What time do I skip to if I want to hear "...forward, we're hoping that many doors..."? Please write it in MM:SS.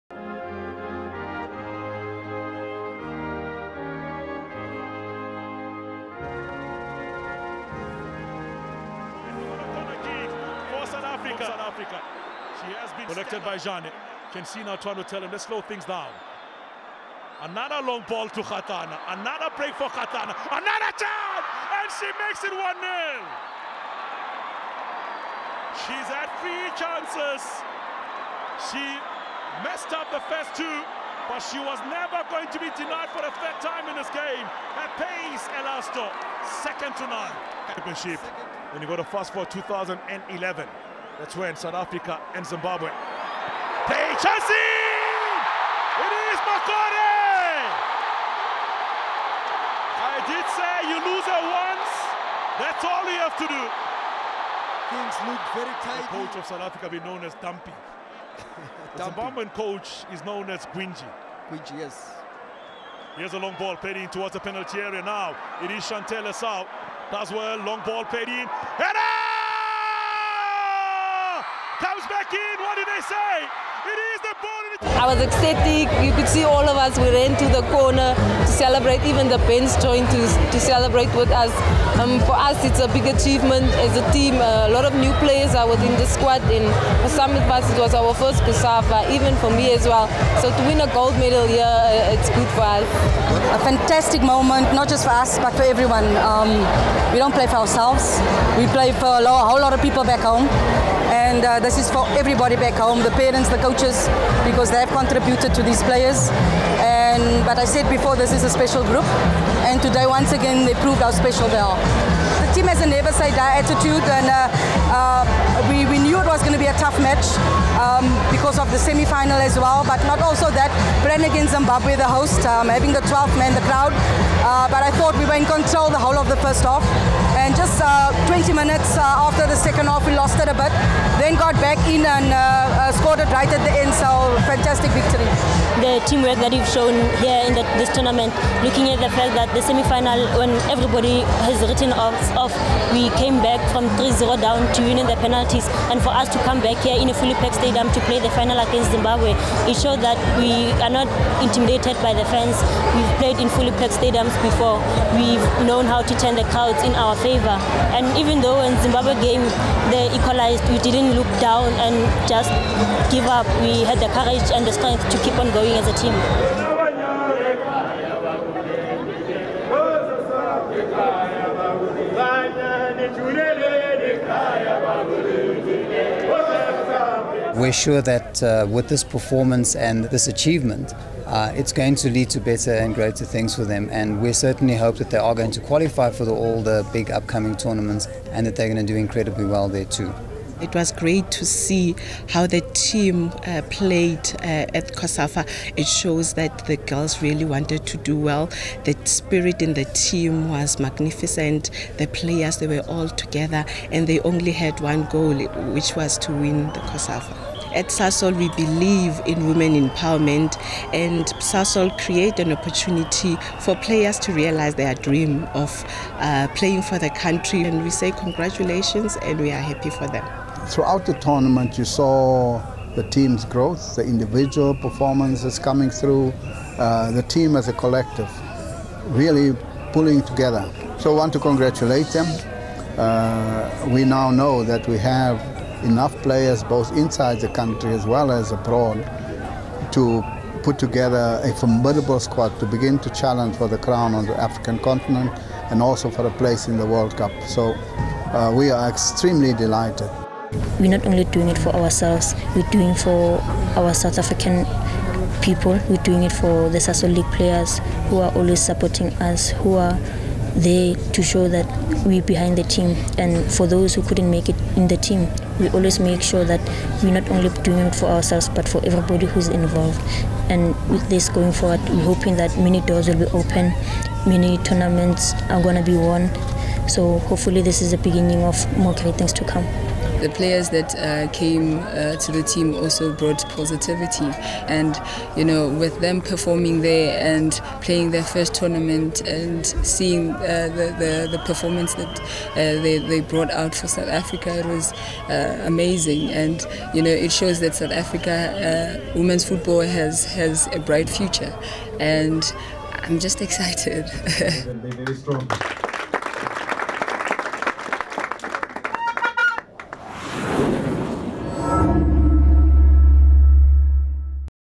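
04:31.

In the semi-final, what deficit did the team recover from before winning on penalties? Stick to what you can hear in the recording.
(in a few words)
3-0.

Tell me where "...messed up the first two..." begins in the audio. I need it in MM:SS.
00:29.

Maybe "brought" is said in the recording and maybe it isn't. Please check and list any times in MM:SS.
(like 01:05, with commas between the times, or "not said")
04:43, 04:53.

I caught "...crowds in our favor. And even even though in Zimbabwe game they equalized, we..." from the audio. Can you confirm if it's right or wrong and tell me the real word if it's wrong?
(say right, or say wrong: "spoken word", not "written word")
right.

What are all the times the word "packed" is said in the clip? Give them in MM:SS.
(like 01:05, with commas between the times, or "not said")
02:27, 02:33.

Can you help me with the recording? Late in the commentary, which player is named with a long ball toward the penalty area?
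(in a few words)
Chantelle Esau.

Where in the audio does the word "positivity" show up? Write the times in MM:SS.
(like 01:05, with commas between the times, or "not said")
04:43.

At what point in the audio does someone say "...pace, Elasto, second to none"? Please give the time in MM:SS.
00:35.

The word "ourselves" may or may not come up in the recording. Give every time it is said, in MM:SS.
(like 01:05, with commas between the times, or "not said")
01:37, 04:11, 04:28.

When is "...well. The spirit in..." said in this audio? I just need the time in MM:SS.
03:18.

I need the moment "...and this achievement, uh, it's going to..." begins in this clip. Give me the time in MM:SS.
02:59.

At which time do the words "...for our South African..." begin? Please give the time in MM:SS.
04:12.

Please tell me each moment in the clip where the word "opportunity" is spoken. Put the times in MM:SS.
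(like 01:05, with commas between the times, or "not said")
03:32.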